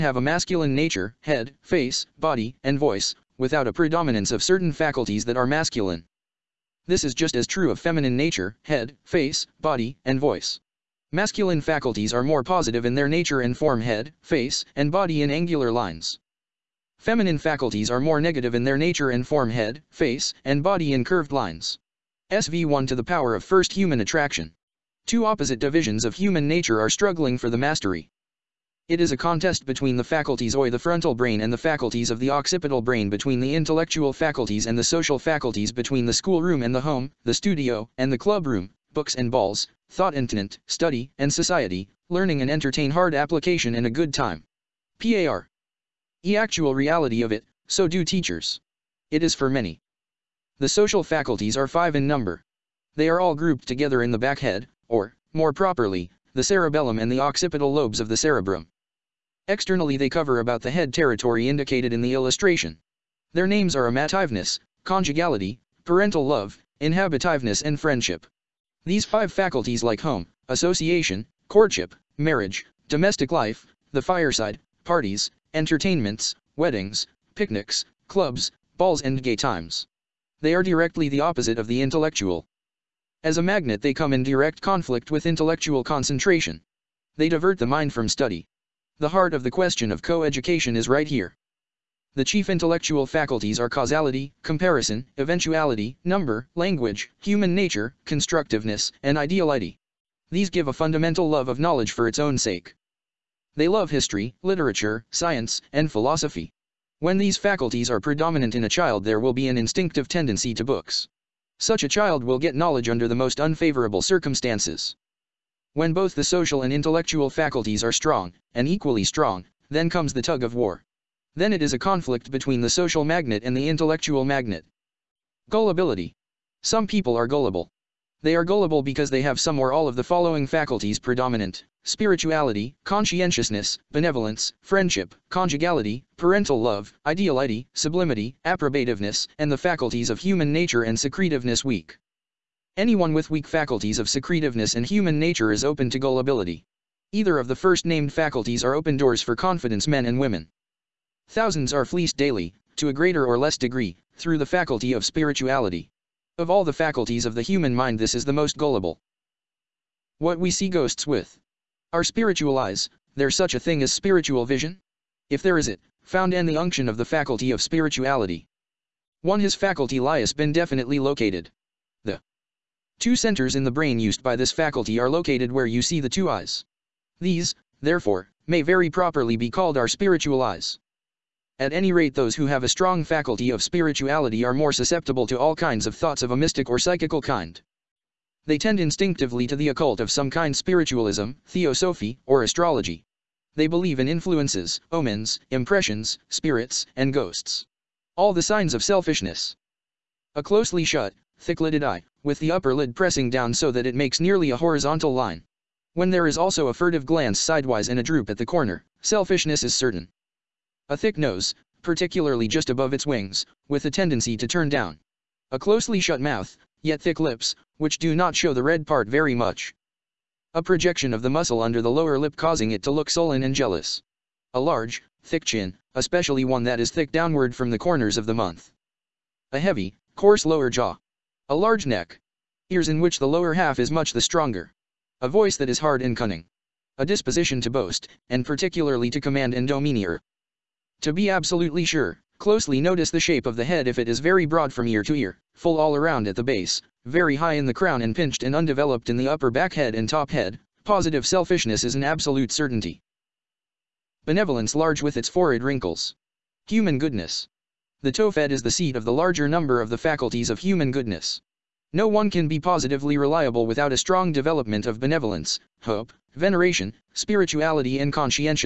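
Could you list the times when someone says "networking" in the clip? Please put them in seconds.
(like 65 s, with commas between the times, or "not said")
not said.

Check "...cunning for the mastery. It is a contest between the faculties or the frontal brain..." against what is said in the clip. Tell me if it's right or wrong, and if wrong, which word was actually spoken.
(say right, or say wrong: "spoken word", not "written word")
wrong: "struggling", not "cunning".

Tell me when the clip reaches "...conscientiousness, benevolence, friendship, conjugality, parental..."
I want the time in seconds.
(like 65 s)
132 s.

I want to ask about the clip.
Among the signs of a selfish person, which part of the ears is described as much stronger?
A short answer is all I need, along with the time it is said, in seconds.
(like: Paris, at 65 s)
Lower half, at 233 s.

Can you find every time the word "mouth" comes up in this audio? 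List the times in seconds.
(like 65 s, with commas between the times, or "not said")
216 s, 228 s.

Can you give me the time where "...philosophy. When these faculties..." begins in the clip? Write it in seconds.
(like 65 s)
105 s.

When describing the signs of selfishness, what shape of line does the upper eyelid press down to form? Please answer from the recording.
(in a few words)
Horizontal line.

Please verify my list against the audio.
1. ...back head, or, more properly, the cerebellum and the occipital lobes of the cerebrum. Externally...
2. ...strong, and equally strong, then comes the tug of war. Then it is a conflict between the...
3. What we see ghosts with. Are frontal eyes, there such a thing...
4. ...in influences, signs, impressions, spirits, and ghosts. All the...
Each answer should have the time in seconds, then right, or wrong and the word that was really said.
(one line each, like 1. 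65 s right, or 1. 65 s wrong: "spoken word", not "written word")
1. 54 s right
2. 117 s right
3. 160 s wrong: "spiritual", not "frontal"
4. 193 s wrong: "omens", not "signs".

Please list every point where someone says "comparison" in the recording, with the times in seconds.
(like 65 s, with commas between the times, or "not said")
94 s.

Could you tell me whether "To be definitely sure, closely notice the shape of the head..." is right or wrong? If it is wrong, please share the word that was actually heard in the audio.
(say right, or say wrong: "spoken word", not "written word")
wrong: "absolutely", not "definitely".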